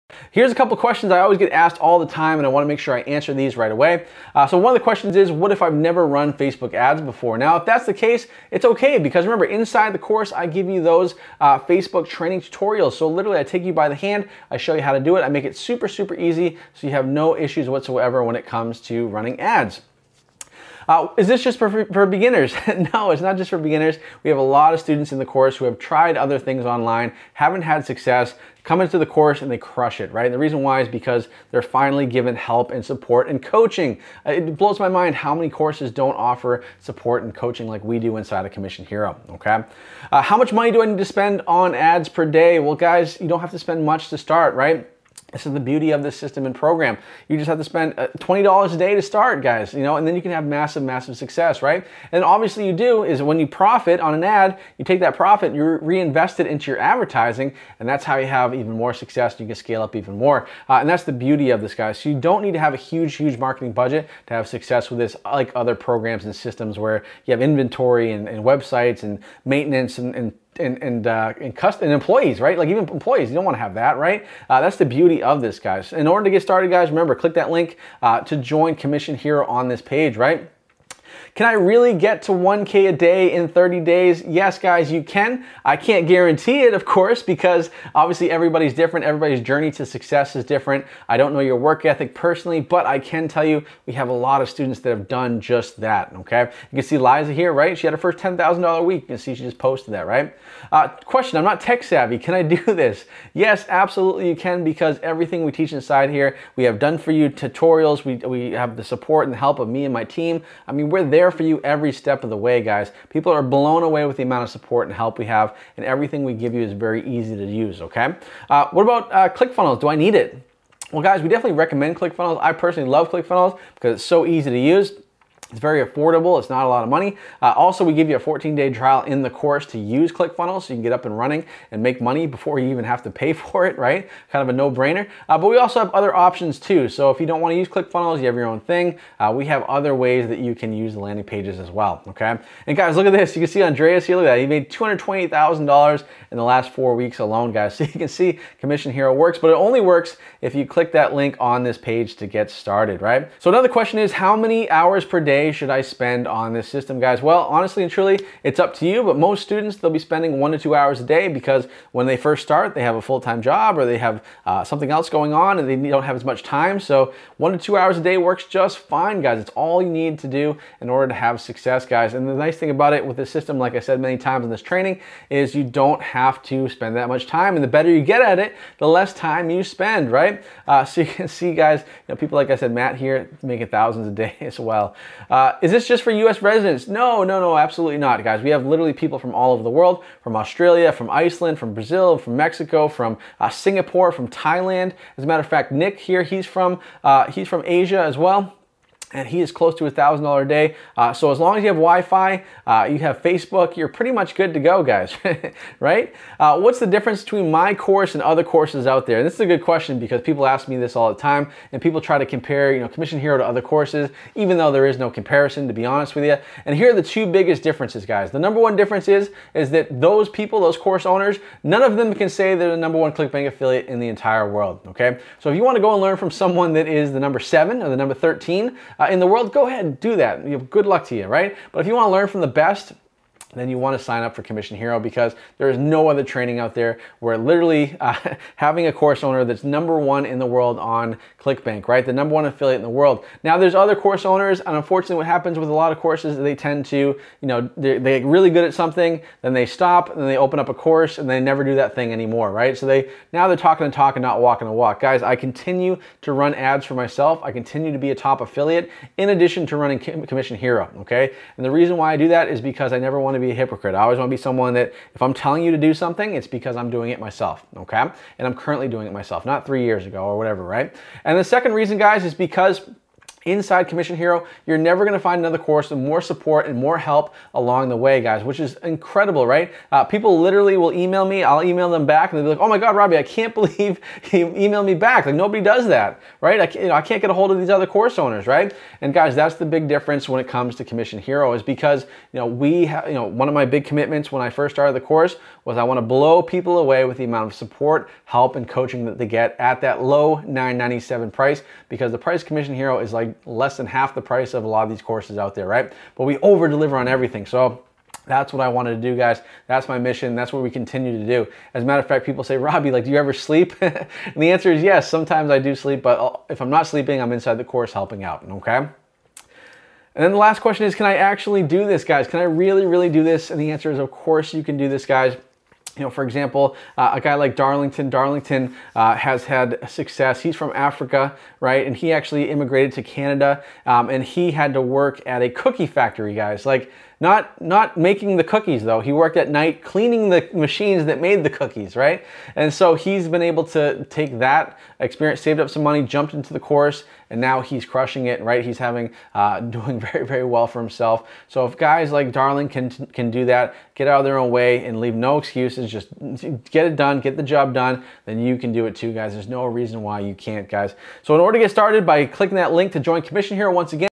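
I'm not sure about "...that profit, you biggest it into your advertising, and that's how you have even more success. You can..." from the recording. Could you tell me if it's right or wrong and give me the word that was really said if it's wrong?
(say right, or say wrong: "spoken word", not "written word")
wrong: "reinvest", not "biggest".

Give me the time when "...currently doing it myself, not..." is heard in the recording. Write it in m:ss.
4:28.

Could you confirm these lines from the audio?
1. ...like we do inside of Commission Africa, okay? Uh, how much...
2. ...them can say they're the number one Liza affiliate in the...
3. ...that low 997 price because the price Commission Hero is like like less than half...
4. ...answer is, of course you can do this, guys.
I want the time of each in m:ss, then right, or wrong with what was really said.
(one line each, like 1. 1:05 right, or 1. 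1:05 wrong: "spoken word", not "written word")
1. 0:37 wrong: "Hero", not "Africa"
2. 3:41 wrong: "ClickBank", not "Liza"
3. 4:59 right
4. 5:23 right.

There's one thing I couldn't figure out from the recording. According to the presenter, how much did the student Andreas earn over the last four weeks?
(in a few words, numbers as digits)
$228,000.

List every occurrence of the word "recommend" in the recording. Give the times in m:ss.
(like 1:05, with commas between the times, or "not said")
2:01.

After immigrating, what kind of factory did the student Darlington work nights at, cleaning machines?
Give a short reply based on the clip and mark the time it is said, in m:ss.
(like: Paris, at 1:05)
Cookie factory, at 5:35.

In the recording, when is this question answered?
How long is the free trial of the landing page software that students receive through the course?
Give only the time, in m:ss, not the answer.
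2:08.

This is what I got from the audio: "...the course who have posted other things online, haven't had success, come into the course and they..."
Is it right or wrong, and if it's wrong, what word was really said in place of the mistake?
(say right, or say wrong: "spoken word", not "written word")
wrong: "tried", not "posted".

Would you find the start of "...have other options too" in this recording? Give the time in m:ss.
2:15.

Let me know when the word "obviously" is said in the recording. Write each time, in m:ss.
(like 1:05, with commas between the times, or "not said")
0:52, 1:27.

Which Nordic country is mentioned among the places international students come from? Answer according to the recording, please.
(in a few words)
Iceland.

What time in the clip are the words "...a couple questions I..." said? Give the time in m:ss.
0:00.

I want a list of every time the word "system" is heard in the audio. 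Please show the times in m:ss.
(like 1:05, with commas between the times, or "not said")
0:46, 1:06, 2:36, 2:53.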